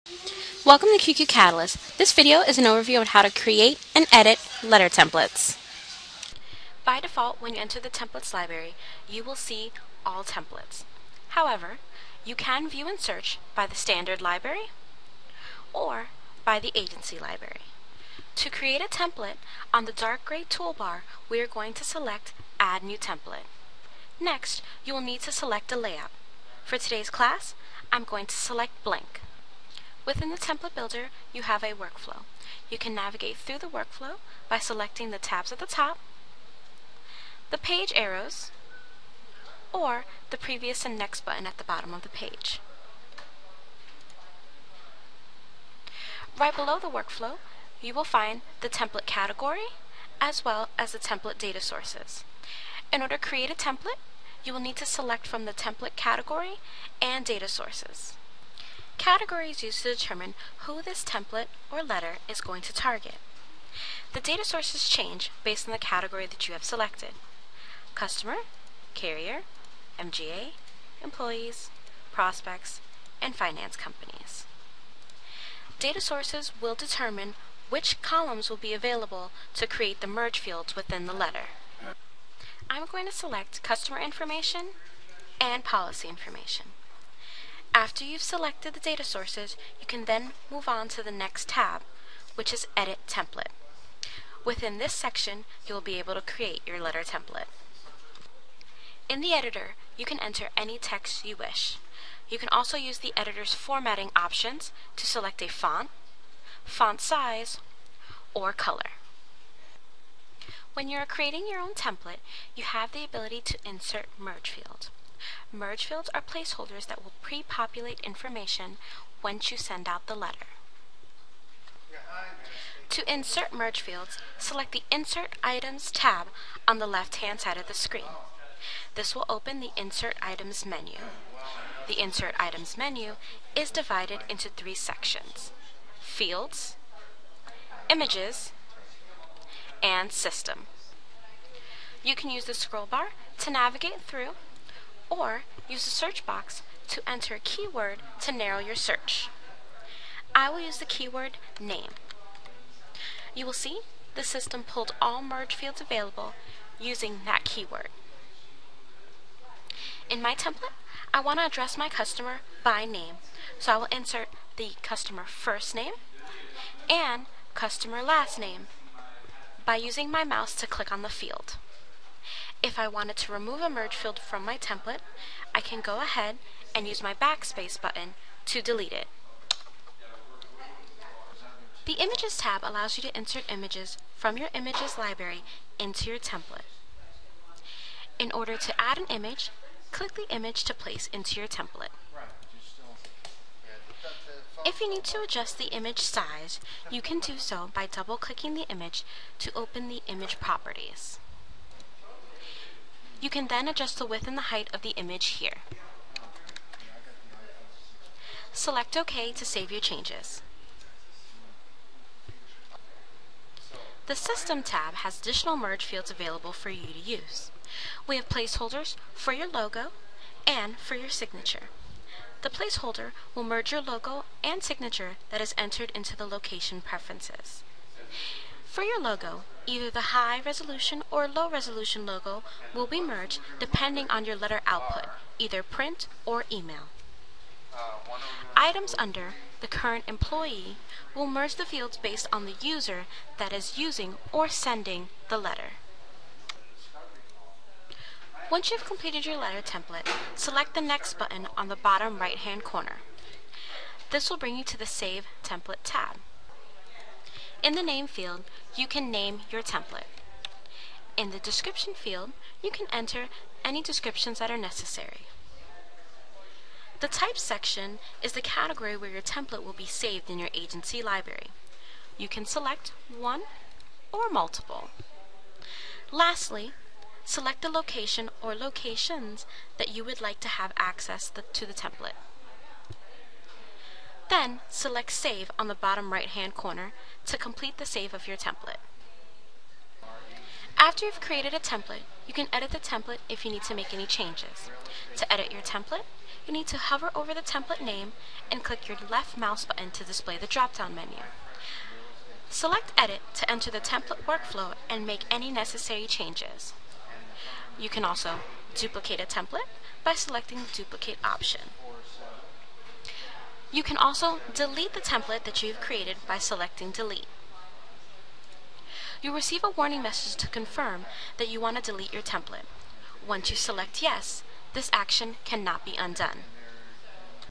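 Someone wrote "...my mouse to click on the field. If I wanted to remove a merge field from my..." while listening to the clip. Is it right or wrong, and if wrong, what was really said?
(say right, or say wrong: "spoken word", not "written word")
right.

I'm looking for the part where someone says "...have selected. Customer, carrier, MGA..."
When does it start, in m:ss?
1:06.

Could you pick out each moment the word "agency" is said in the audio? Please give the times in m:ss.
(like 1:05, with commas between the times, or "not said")
0:16, 4:30.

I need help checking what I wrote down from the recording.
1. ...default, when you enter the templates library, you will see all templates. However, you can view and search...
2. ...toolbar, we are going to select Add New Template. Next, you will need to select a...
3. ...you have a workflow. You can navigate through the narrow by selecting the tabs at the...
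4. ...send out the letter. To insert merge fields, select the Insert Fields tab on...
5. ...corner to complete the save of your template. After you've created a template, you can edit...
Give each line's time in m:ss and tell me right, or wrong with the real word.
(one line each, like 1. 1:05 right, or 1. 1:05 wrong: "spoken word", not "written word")
1. 0:06 right
2. 0:20 right
3. 0:31 wrong: "workflow", not "narrow"
4. 1:59 wrong: "Items", not "Fields"
5. 4:46 right.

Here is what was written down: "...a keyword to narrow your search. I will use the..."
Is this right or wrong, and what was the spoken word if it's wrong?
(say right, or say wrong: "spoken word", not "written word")
right.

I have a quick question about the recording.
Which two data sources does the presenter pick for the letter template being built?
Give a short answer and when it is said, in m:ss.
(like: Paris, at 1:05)
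Customer information and policy information, at 1:23.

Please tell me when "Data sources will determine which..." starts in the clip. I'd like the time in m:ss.
1:15.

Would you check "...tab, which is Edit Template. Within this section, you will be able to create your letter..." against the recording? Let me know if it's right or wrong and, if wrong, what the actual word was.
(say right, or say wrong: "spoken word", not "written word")
right.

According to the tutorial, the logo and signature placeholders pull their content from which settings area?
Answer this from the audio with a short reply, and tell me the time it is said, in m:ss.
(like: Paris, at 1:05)
Location preferences, at 3:46.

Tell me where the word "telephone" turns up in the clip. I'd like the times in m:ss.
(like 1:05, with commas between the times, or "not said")
not said.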